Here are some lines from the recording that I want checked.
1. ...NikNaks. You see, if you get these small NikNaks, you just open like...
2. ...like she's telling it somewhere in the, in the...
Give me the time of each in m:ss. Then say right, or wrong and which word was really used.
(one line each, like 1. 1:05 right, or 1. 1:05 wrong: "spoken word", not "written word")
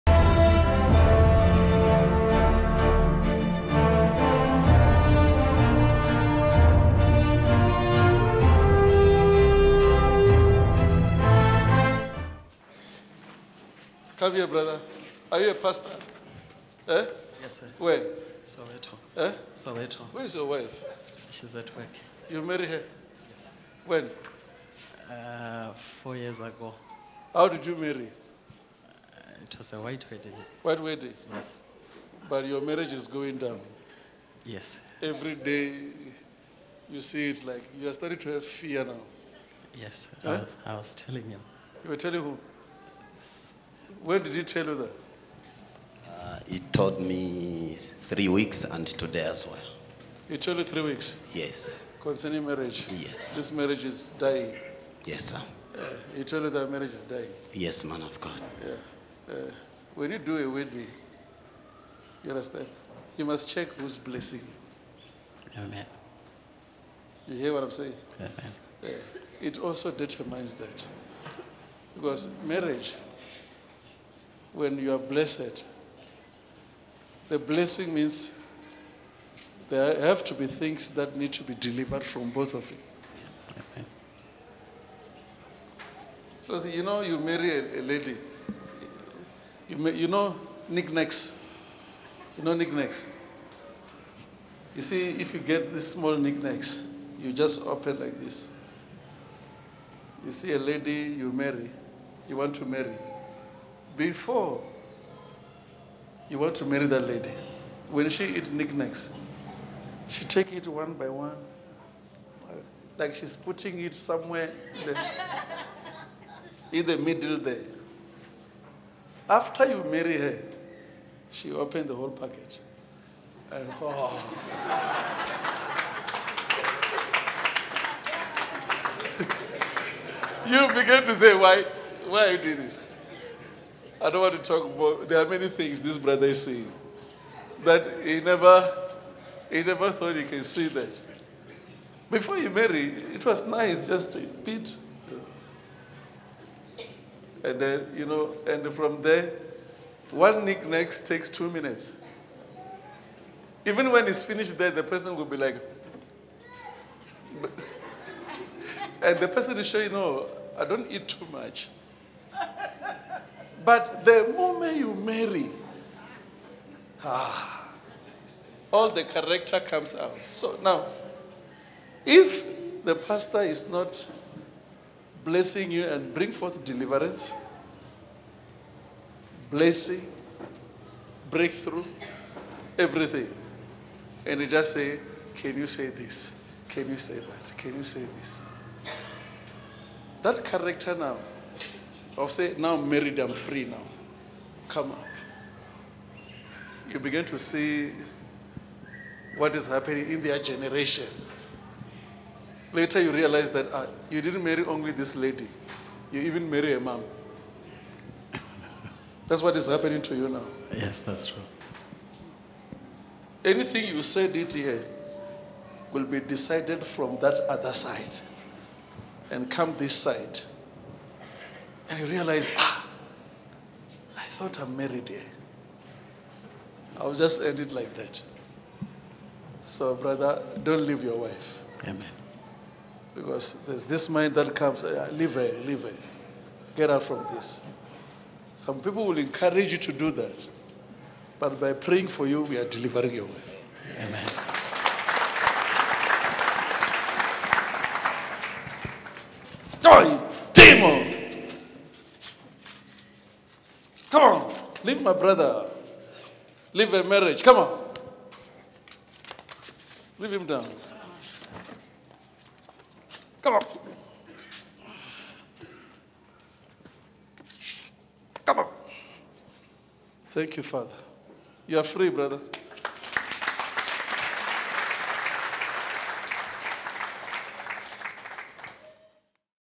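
1. 1:32 right
2. 1:52 wrong: "putting", not "telling".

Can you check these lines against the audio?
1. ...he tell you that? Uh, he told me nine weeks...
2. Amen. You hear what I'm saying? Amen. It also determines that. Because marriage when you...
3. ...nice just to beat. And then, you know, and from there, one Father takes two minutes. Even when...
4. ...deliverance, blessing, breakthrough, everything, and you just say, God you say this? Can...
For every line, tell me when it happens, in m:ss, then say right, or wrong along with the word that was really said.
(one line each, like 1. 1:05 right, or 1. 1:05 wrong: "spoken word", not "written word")
1. 0:44 wrong: "three", not "nine"
2. 1:05 right
3. 2:23 wrong: "NikNak", not "Father"
4. 2:56 wrong: "Can", not "God".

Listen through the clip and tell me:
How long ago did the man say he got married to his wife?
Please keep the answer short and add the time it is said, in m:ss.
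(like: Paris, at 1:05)
4 years ago, at 0:25.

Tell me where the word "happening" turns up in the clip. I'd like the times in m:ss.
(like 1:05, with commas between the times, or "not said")
3:19, 3:29.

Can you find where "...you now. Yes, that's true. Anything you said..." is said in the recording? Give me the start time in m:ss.
3:30.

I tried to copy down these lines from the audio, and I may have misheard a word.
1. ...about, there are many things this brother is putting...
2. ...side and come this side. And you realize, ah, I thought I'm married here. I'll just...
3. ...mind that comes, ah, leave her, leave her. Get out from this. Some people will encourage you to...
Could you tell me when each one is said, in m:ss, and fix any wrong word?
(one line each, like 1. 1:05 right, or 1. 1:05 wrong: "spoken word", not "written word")
1. 2:14 wrong: "seeing", not "putting"
2. 3:37 right
3. 3:54 right.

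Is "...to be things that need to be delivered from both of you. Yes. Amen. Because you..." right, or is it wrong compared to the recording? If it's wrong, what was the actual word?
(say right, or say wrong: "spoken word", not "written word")
right.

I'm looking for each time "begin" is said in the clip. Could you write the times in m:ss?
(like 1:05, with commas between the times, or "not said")
2:10, 3:16.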